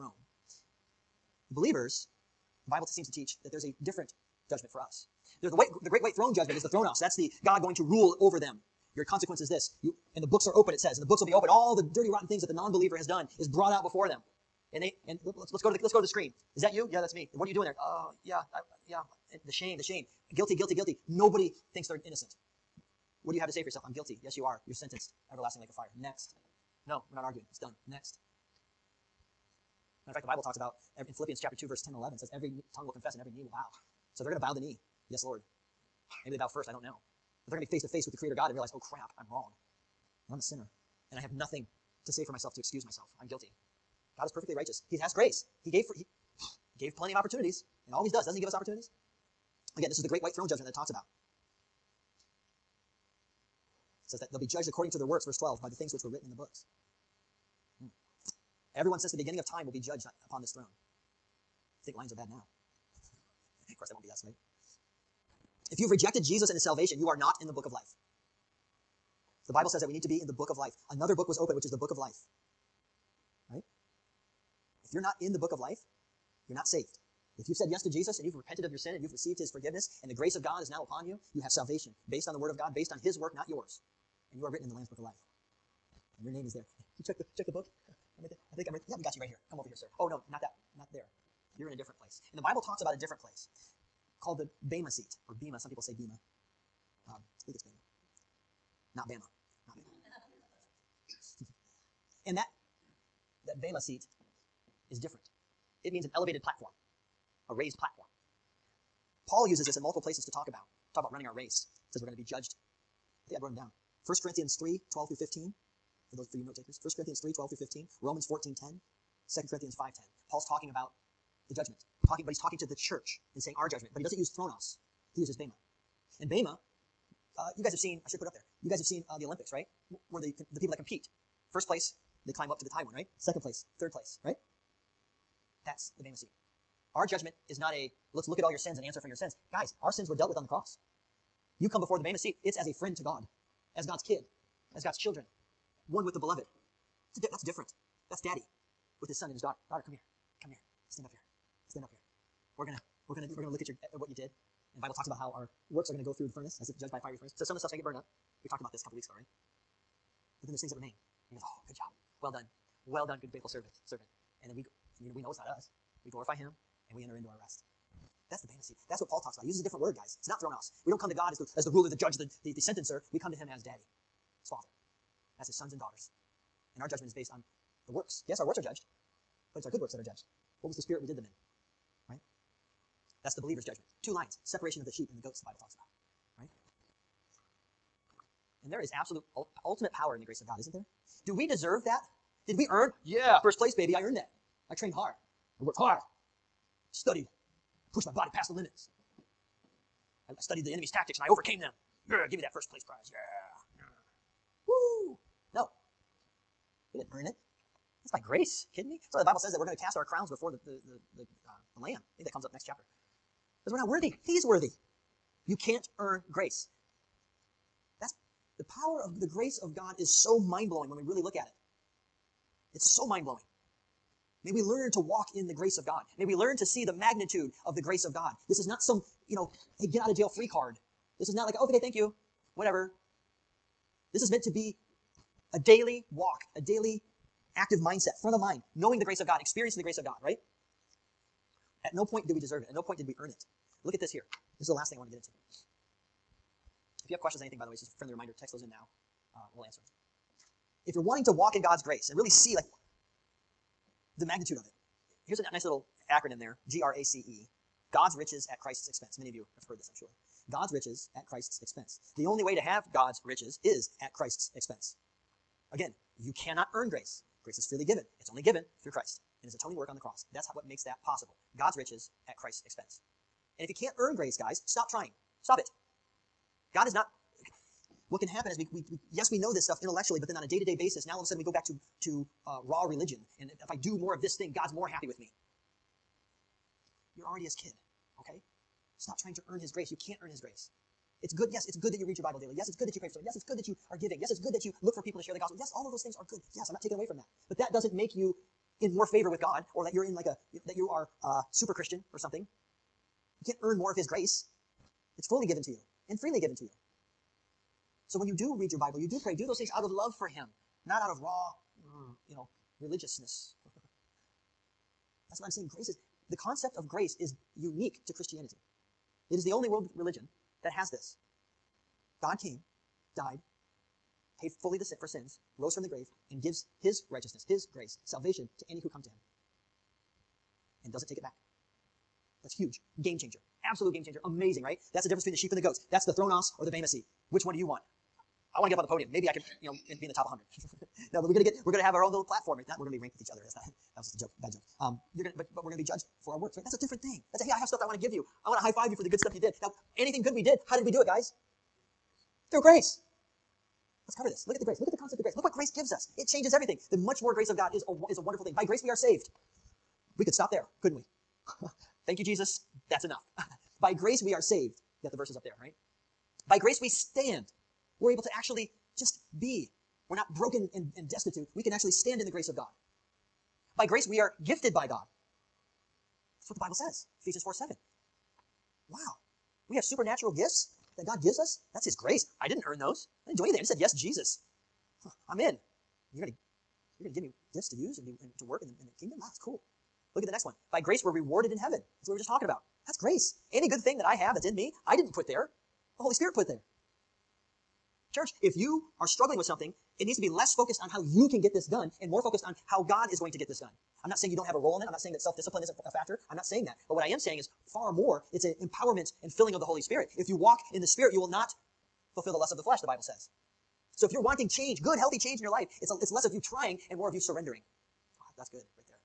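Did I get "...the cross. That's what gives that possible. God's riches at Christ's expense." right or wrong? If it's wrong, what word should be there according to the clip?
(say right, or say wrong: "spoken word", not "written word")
wrong: "makes", not "gives".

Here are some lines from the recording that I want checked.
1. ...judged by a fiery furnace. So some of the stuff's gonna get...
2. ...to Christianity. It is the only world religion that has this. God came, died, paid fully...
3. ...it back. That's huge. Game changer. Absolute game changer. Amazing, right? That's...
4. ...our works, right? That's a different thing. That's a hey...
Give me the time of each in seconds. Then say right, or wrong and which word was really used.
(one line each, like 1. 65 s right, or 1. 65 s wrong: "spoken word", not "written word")
1. 156 s right
2. 318 s right
3. 331 s right
4. 346 s right.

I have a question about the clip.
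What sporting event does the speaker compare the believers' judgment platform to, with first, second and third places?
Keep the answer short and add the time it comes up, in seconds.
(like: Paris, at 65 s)
the Olympics, at 129 s.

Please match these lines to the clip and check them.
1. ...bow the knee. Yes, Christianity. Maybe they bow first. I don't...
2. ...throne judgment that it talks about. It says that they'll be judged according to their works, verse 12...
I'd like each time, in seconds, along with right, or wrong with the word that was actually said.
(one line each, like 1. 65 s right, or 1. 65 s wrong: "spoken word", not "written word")
1. 34 s wrong: "Lord", not "Christianity"
2. 50 s right.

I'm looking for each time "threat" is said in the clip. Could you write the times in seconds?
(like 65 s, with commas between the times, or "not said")
not said.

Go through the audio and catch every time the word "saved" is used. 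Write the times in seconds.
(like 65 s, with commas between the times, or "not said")
358 s, 364 s.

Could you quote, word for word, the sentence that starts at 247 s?
If you have questions on anything, by the way, it's just a friendly reminder, text those in now.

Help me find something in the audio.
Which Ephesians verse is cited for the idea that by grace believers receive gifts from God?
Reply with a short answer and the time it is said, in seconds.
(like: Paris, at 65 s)
Ephesians 4:7, at 377 s.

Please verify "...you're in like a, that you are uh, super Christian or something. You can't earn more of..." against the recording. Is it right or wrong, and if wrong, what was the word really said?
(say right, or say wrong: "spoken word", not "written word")
right.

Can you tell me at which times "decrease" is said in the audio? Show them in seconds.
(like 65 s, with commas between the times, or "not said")
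not said.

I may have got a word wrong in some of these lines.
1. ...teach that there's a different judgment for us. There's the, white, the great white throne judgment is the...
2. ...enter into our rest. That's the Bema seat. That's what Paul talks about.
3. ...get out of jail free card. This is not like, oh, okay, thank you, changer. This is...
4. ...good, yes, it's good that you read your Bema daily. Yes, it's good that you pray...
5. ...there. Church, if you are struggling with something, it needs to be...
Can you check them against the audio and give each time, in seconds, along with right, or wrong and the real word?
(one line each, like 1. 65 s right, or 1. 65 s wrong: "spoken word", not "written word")
1. 3 s right
2. 167 s right
3. 229 s wrong: "whatever", not "changer"
4. 291 s wrong: "Bible", not "Bema"
5. 396 s right.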